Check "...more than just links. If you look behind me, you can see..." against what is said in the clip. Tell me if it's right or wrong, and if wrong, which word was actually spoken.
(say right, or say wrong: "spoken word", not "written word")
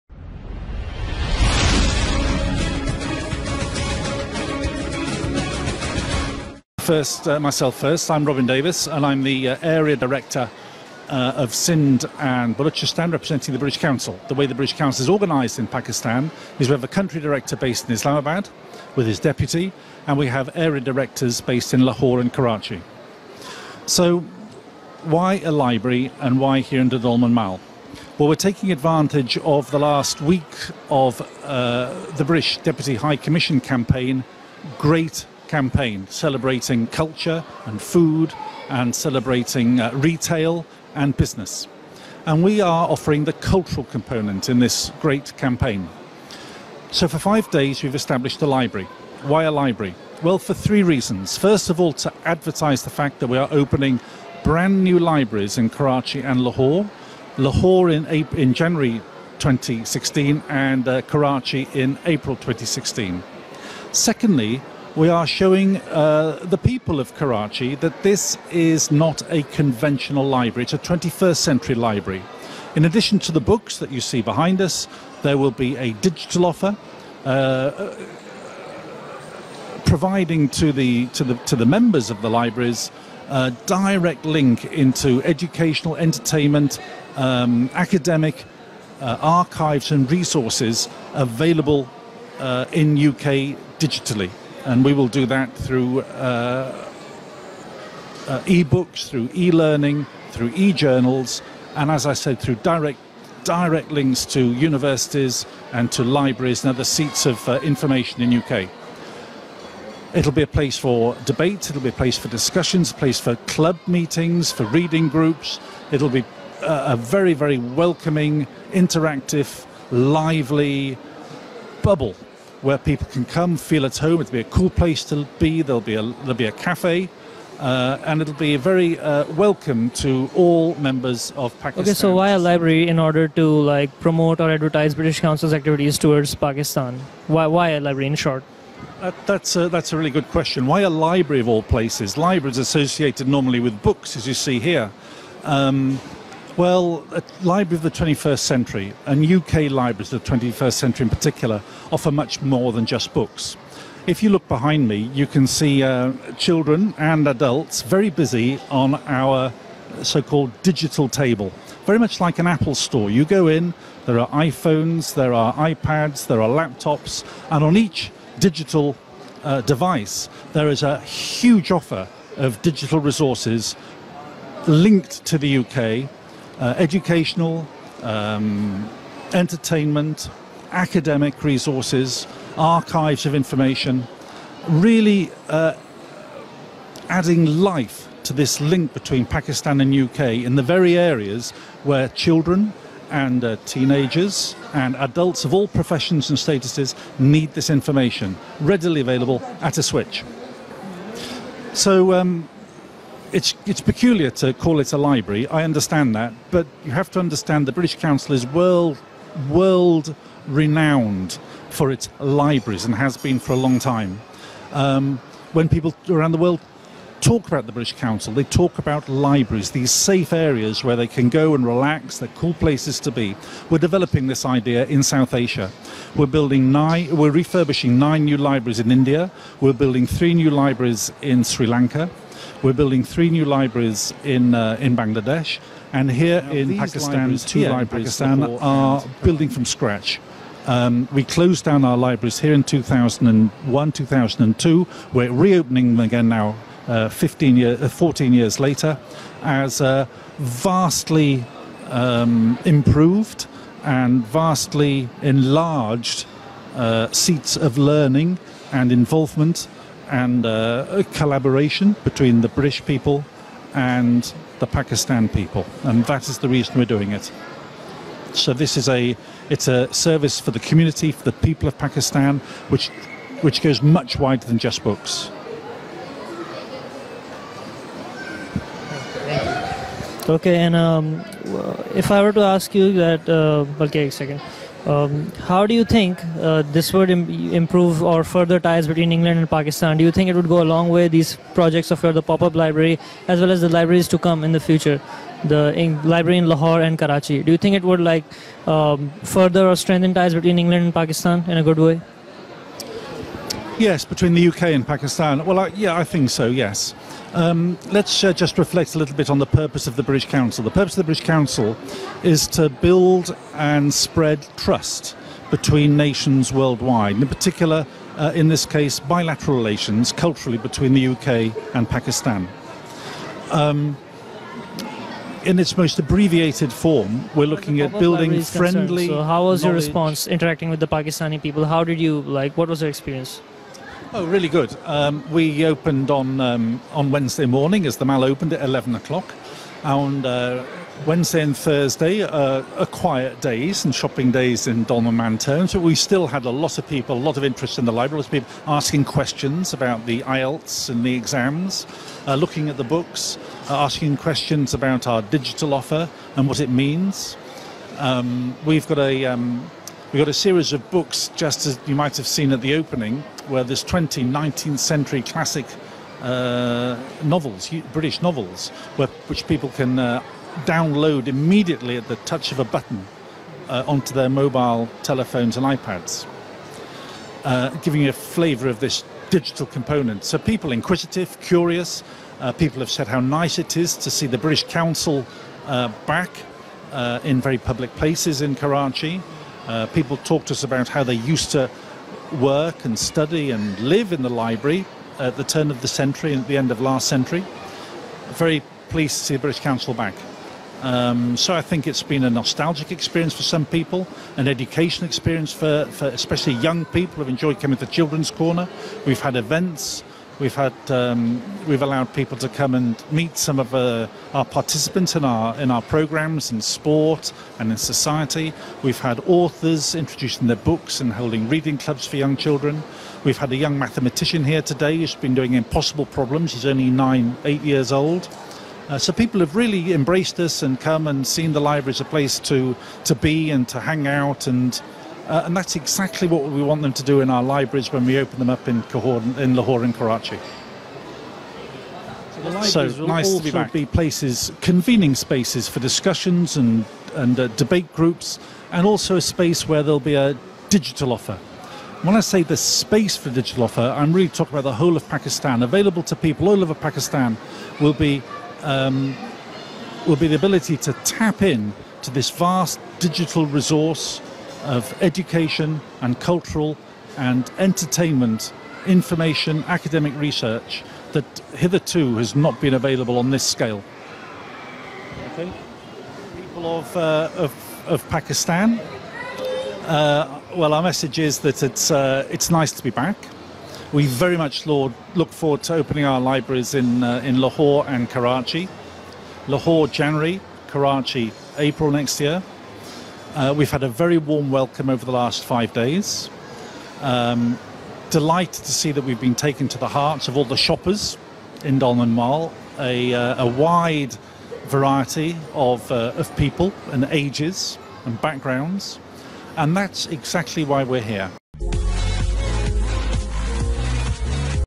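wrong: "books", not "links".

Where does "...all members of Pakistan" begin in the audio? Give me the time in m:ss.
2:10.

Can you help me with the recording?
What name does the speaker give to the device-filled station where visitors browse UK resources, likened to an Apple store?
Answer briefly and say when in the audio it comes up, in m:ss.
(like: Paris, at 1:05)
digital table, at 2:40.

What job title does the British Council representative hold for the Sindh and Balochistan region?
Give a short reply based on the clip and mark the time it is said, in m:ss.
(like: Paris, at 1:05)
Area Director, at 0:09.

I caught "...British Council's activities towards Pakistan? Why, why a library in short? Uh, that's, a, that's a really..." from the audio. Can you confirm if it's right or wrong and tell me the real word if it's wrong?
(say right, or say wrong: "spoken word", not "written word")
right.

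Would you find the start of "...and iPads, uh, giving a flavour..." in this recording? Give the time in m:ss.
6:15.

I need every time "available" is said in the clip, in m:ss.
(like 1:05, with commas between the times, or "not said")
1:31, 3:19, 7:35, 7:52.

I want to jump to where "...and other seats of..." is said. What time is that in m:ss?
1:46.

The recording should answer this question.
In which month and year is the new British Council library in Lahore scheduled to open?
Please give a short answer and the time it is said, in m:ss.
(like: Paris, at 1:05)
January 2016, at 0:58.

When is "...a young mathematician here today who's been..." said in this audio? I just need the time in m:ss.
7:03.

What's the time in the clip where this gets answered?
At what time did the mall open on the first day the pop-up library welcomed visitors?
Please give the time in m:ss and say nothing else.
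5:38.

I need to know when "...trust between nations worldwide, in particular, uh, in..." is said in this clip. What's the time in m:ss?
5:14.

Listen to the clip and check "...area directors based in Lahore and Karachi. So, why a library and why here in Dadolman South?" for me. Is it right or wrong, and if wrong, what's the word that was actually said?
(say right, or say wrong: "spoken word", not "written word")
wrong: "Mall", not "South".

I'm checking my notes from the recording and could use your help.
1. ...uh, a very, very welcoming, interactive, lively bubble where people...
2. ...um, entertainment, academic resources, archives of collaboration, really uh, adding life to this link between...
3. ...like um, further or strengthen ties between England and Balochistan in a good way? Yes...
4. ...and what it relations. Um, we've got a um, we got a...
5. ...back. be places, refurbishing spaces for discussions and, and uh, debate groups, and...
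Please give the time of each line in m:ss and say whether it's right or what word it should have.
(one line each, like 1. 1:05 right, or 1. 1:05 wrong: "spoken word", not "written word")
1. 1:56 right
2. 2:58 wrong: "information", not "collaboration"
3. 4:57 wrong: "Pakistan", not "Balochistan"
4. 5:56 wrong: "means", not "relations"
5. 7:23 wrong: "convening", not "refurbishing".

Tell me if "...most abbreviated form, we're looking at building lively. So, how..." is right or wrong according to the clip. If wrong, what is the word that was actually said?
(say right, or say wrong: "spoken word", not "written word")
wrong: "friendly", not "lively".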